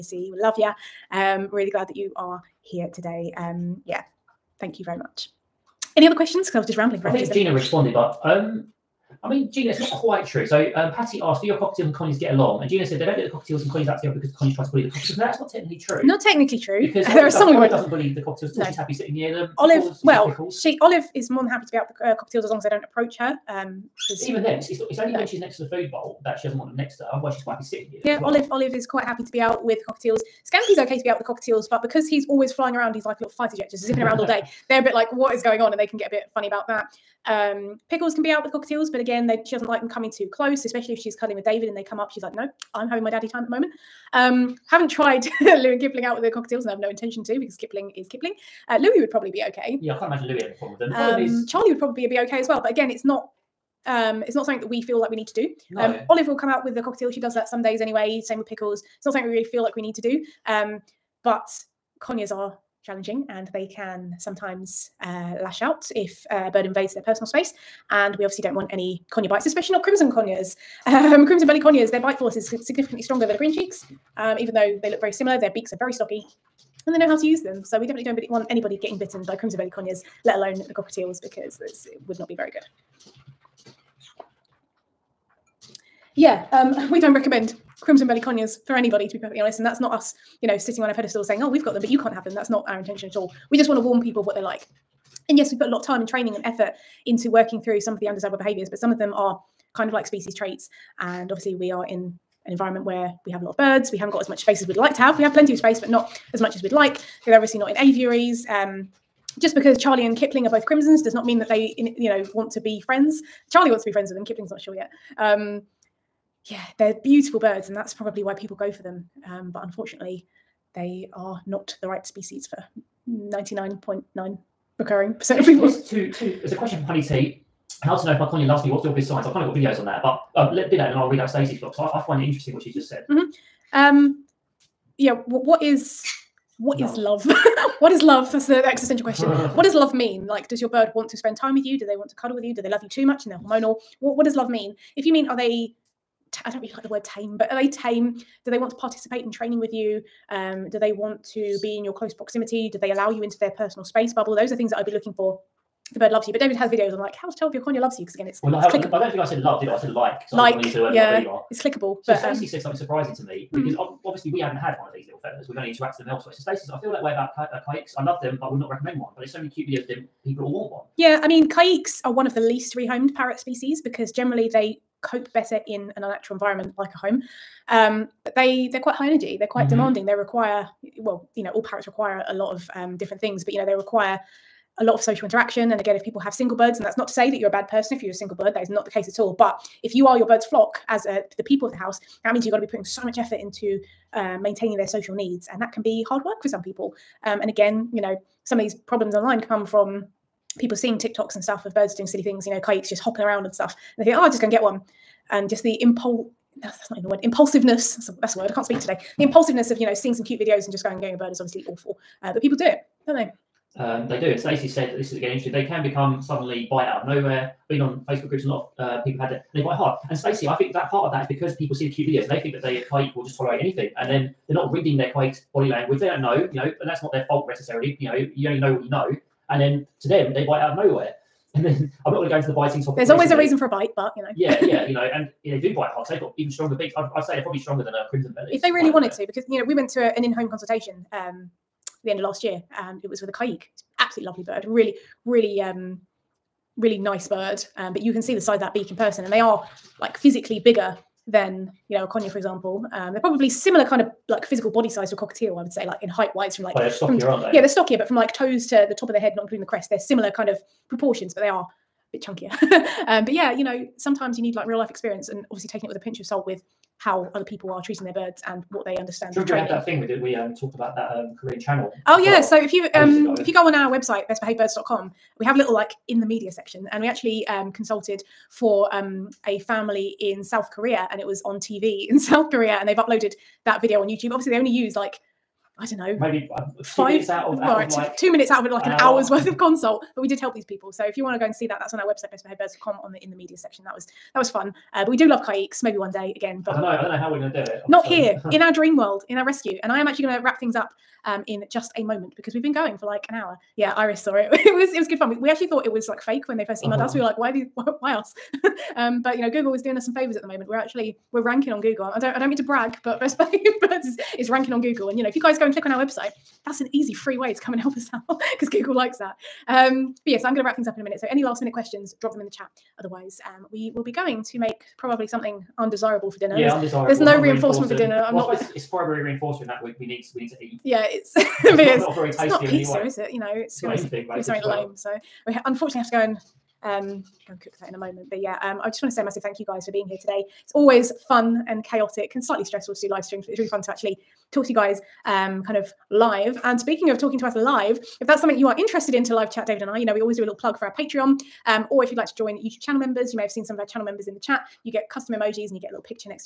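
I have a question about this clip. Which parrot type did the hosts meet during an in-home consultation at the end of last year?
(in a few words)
Caique.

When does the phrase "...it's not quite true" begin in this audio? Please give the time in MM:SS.
00:09.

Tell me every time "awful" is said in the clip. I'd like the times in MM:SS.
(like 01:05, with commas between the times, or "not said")
03:31.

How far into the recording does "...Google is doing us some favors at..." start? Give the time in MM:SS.
05:09.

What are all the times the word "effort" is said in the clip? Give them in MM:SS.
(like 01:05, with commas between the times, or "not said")
01:36, 03:13.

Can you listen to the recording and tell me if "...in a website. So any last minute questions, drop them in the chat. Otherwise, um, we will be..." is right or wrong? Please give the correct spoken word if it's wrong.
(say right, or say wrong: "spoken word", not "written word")
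wrong: "minute", not "website".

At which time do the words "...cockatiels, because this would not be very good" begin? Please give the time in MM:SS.
01:20.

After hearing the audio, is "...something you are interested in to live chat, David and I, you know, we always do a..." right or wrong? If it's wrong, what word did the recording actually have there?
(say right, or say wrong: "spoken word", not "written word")
right.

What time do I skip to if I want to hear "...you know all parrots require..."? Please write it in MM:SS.
03:01.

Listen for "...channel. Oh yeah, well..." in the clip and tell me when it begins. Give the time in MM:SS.
04:31.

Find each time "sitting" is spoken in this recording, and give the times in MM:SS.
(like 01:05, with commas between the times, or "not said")
00:18, 00:27, 01:30.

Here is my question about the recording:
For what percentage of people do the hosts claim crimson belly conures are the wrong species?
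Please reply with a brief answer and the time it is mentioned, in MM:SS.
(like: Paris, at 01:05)
99.9 recurring percent, at 02:03.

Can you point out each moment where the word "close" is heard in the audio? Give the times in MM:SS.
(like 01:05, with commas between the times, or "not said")
00:40, 02:31.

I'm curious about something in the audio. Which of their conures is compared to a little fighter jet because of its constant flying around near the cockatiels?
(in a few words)
Scampy.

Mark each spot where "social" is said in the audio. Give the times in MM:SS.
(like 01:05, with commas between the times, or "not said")
03:04, 03:14.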